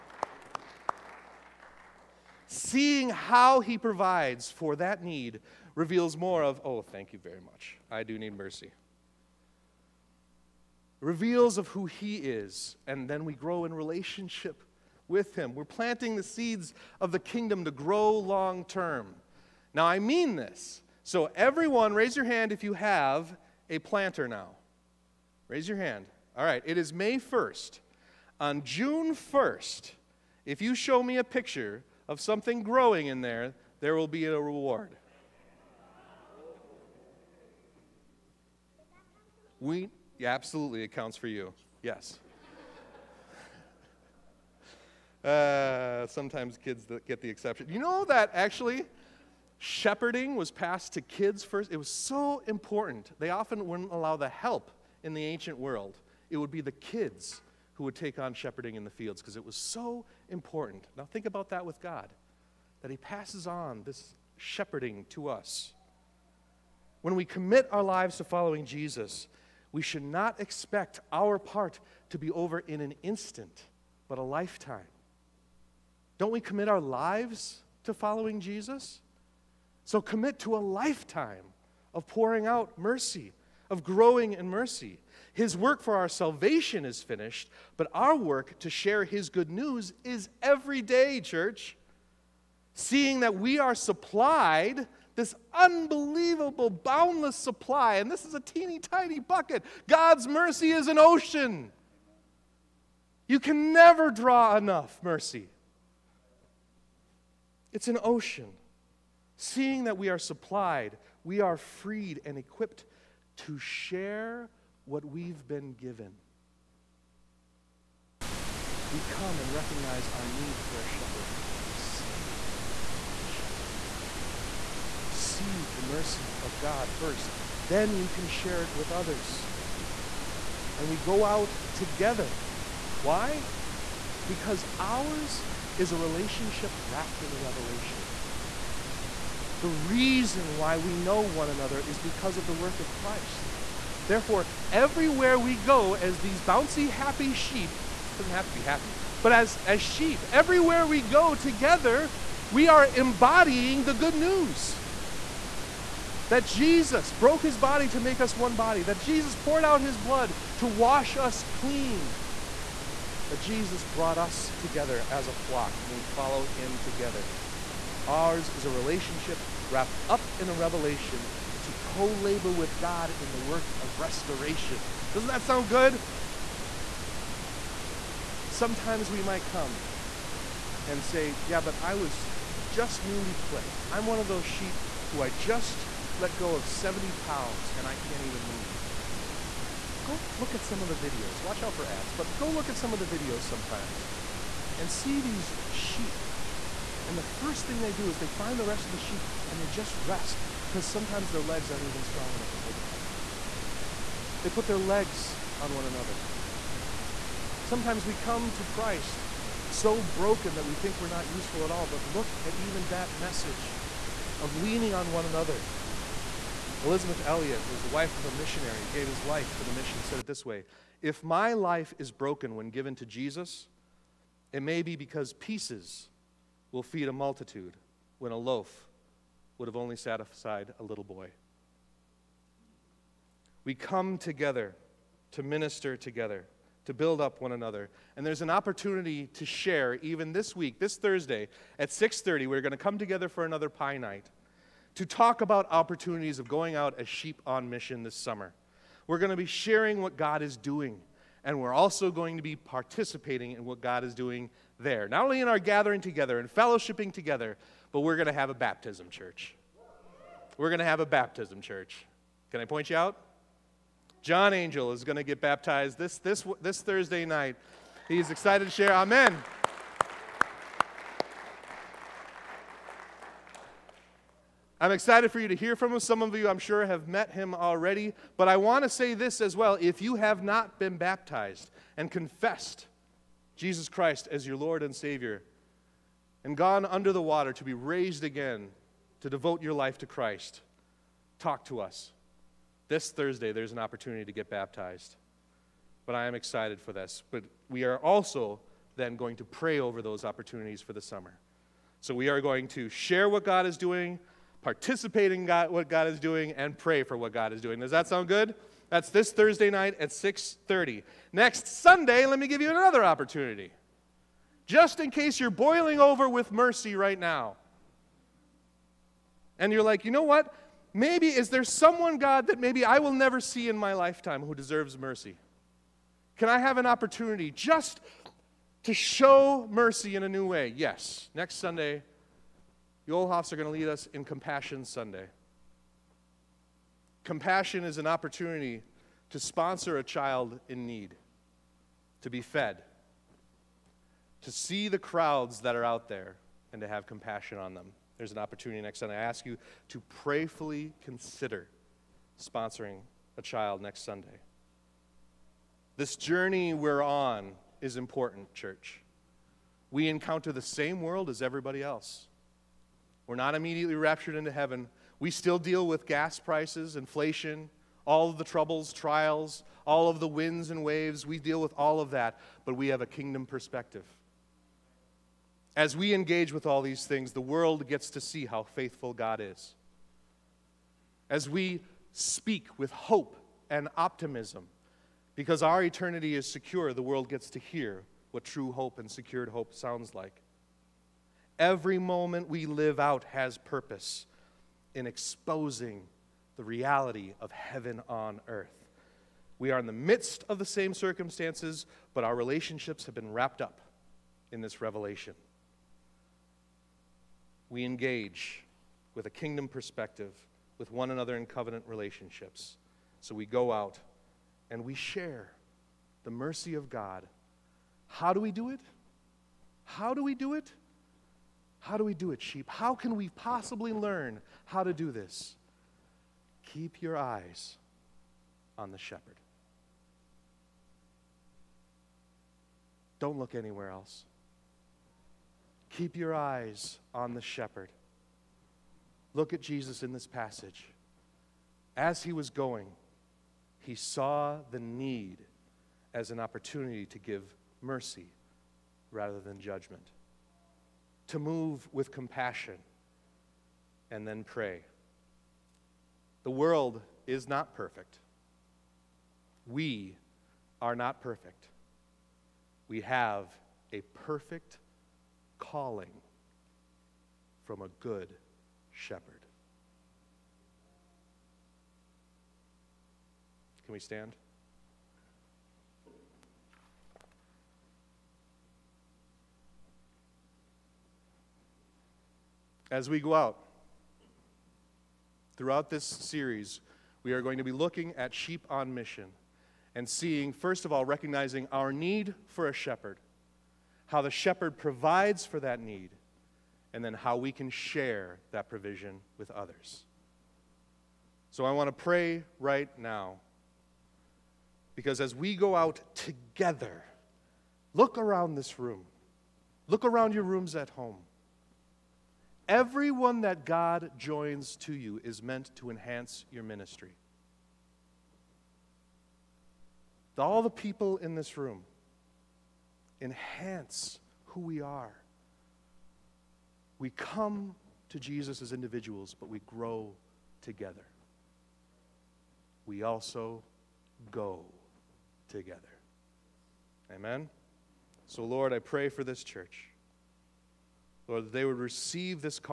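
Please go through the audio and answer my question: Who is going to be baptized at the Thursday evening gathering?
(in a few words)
John Angel.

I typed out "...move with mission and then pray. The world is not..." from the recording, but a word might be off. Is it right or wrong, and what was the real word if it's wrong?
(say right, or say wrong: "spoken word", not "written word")
wrong: "compassion", not "mission".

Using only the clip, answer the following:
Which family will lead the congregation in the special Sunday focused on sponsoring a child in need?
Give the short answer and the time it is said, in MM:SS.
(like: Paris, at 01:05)
the Olhoffs, at 05:33.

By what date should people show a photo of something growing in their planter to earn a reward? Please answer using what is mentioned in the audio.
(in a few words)
June 1st.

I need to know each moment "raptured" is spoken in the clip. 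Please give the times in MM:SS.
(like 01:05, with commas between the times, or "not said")
06:03.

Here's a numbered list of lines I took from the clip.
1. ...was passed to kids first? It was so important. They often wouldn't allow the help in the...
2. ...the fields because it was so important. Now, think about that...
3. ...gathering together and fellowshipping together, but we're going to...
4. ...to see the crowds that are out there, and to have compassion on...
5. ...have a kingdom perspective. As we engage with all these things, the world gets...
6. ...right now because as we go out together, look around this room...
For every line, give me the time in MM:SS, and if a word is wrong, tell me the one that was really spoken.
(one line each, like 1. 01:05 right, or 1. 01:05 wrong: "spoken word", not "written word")
1. 00:50 right
2. 00:58 right
3. 04:15 right
4. 05:44 right
5. 06:12 right
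6. 08:22 right.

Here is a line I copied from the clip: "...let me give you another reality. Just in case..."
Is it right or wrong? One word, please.
wrong.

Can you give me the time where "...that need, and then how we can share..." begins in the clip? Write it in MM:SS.
08:15.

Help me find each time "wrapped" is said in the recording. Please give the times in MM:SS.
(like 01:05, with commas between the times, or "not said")
02:16, 02:49, 06:43.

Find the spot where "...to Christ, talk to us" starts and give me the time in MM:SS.
04:49.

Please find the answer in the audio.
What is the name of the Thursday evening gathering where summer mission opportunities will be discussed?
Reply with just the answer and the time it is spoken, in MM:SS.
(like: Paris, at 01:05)
pie night, at 04:03.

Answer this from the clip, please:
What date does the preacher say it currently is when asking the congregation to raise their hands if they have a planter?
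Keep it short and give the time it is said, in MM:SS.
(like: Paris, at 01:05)
May 1st, at 00:26.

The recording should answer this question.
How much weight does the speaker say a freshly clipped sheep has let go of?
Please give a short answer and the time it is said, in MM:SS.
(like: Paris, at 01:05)
70 pounds, at 03:06.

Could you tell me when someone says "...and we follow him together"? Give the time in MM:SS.
02:45.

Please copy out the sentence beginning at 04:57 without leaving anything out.
But we are also then going to pray over those opportunities for the summer.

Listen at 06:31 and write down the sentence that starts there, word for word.
Every moment we live out has purpose in exposing the reality of heaven on earth.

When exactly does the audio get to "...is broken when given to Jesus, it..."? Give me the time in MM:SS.
03:41.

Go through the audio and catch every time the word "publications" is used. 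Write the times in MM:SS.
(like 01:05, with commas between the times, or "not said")
not said.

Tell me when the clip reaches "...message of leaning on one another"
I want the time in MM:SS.
03:33.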